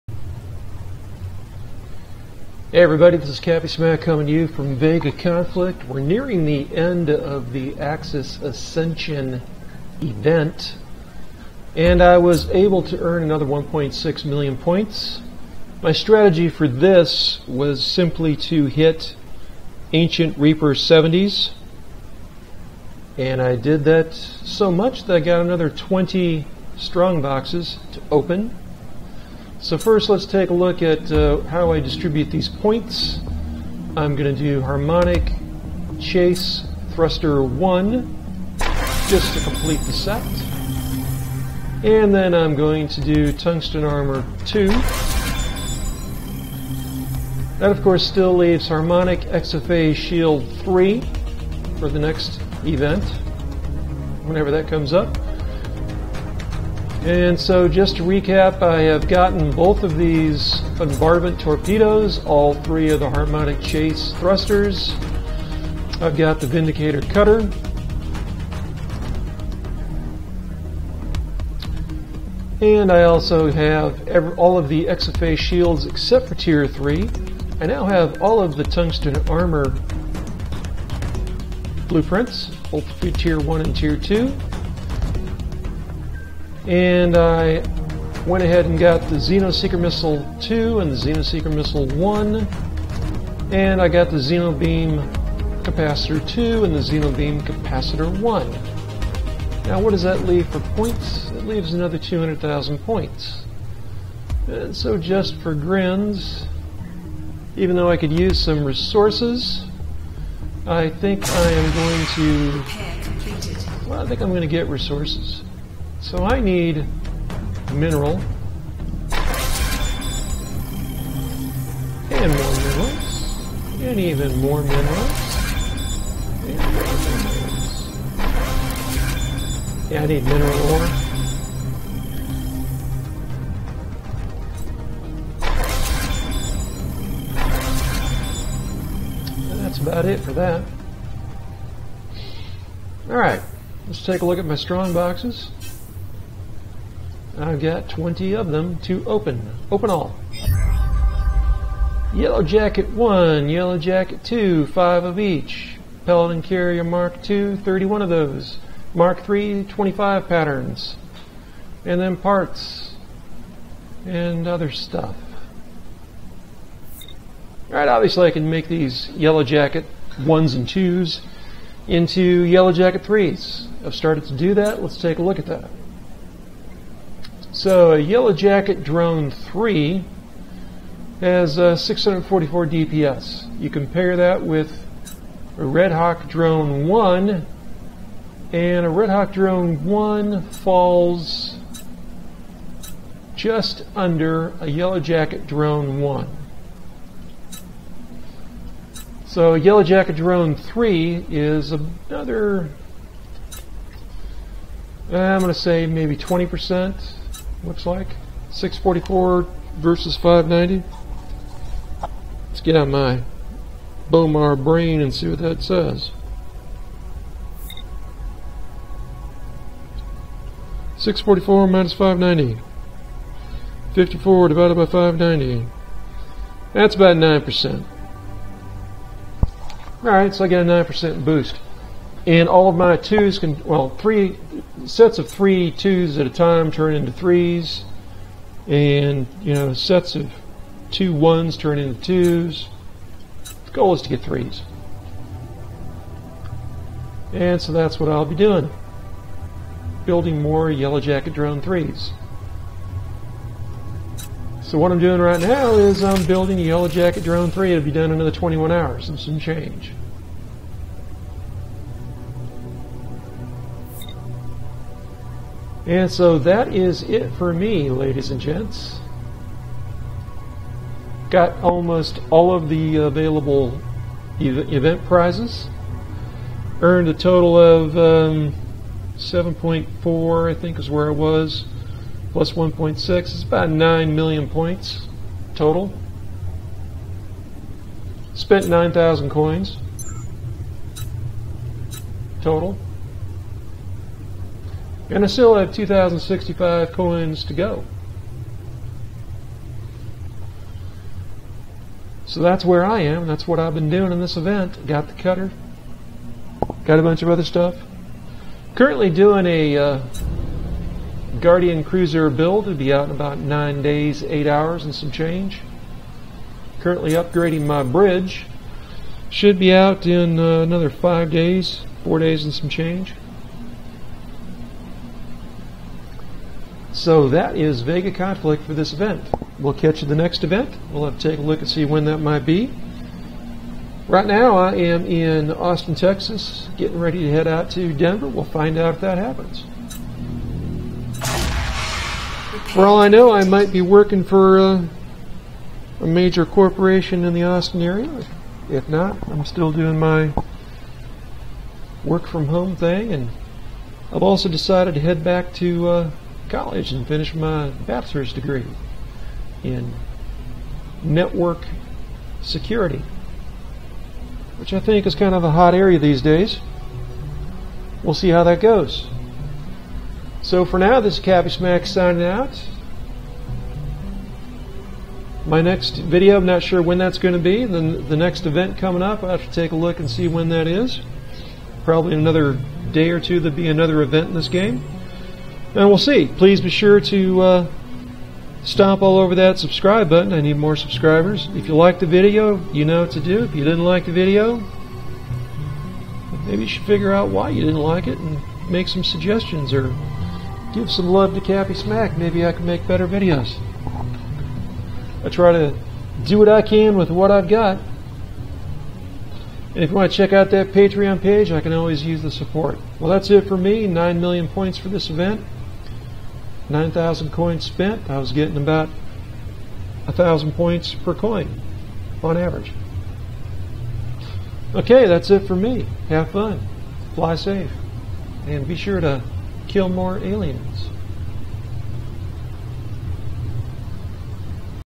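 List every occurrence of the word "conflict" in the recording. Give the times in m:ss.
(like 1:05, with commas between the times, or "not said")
0:05, 5:28.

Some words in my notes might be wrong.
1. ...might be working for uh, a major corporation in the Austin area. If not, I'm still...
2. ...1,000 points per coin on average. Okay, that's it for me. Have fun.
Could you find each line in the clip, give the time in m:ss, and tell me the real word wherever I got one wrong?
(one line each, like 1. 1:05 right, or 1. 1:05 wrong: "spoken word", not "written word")
1. 5:43 right
2. 7:00 right.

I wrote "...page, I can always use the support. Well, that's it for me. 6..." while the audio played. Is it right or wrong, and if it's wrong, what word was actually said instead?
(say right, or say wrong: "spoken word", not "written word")
wrong: "9", not "6".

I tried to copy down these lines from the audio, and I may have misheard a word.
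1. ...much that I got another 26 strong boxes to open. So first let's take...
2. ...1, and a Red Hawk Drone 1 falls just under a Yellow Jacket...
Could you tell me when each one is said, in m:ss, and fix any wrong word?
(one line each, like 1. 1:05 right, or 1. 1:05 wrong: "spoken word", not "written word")
1. 0:24 wrong: "20", not "26"
2. 3:06 right.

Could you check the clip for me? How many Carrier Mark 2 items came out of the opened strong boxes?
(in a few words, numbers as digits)
31.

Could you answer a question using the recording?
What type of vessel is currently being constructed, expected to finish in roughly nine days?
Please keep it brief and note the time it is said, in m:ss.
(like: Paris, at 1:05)
Guardian Cruiser, at 5:11.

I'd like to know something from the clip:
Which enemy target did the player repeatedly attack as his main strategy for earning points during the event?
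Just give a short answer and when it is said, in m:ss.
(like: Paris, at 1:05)
Ancient Reaper 70s, at 0:19.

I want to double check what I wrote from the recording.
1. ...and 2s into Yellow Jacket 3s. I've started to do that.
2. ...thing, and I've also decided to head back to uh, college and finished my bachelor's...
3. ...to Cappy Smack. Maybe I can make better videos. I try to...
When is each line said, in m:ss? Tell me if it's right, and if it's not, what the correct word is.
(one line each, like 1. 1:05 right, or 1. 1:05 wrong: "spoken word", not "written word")
1. 2:50 right
2. 5:52 right
3. 6:41 right.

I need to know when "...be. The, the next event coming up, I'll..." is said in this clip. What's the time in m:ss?
6:17.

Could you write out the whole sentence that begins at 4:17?
It'll be done in another 21 hours and some change.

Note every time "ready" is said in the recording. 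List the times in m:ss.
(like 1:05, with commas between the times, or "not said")
5:36.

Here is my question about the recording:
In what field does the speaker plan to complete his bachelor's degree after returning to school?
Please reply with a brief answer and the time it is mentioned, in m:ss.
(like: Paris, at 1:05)
network security, at 6:01.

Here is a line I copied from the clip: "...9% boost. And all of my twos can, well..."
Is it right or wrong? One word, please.
right.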